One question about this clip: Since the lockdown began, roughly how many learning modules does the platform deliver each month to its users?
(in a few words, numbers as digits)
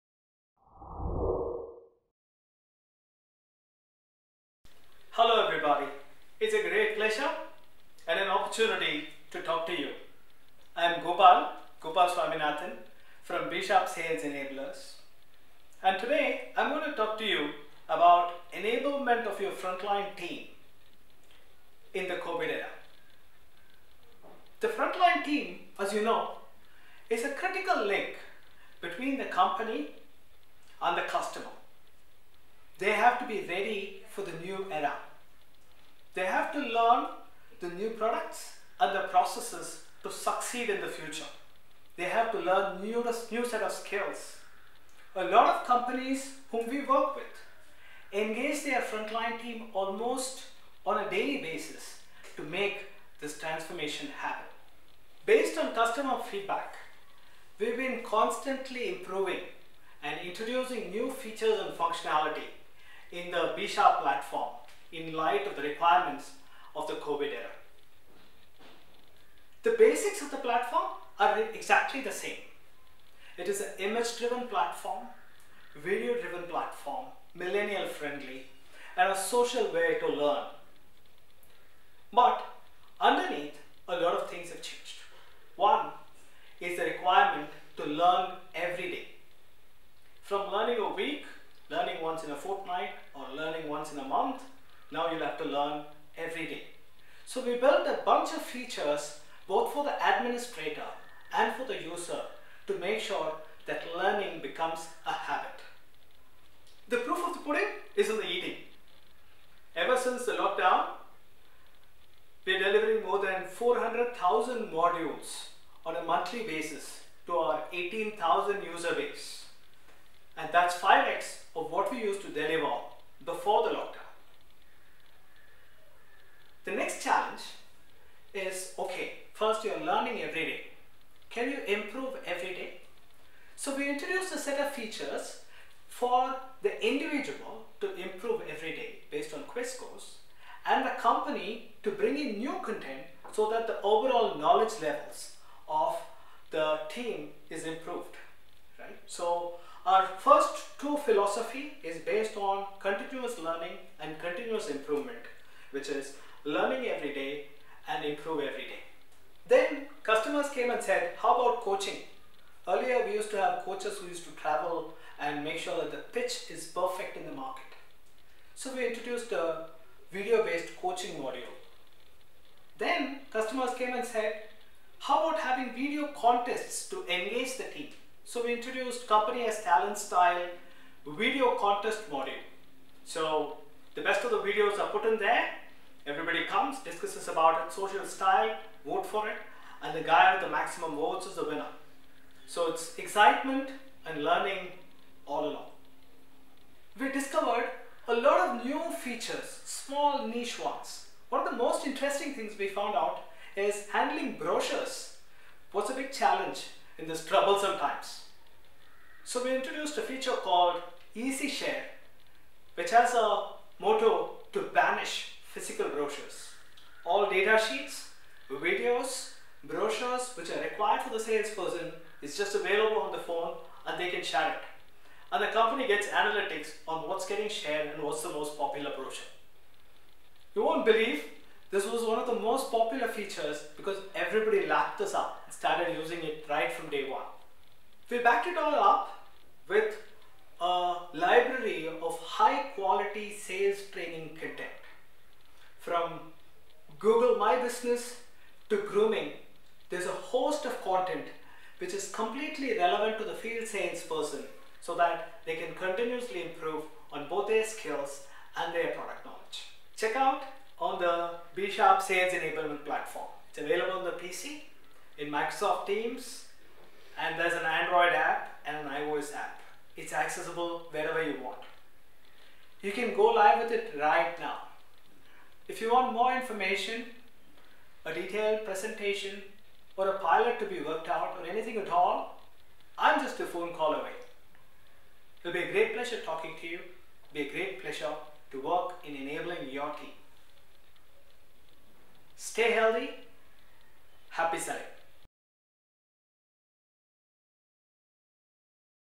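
400,000.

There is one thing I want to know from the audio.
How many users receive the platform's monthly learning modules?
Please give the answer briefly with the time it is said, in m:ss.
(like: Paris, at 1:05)
18,000, at 1:57.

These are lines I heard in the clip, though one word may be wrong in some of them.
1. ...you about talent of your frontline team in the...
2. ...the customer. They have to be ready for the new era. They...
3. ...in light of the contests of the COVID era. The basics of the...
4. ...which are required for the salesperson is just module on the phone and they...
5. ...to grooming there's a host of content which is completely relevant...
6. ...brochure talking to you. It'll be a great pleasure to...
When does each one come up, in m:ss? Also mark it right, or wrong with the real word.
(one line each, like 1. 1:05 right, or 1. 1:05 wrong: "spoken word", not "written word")
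1. 0:17 wrong: "enablement", not "talent"
2. 0:30 right
3. 1:04 wrong: "requirements", not "contests"
4. 3:40 wrong: "available", not "module"
5. 4:08 right
6. 4:45 wrong: "pleasure", not "brochure".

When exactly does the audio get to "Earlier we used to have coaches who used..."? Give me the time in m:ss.
2:42.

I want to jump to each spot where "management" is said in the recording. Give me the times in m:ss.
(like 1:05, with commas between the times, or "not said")
not said.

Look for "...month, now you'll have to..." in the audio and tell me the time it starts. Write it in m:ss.
1:34.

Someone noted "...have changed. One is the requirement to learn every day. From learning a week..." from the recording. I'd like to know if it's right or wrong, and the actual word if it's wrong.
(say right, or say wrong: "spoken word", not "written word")
right.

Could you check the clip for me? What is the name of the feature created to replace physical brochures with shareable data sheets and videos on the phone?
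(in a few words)
Easy Share.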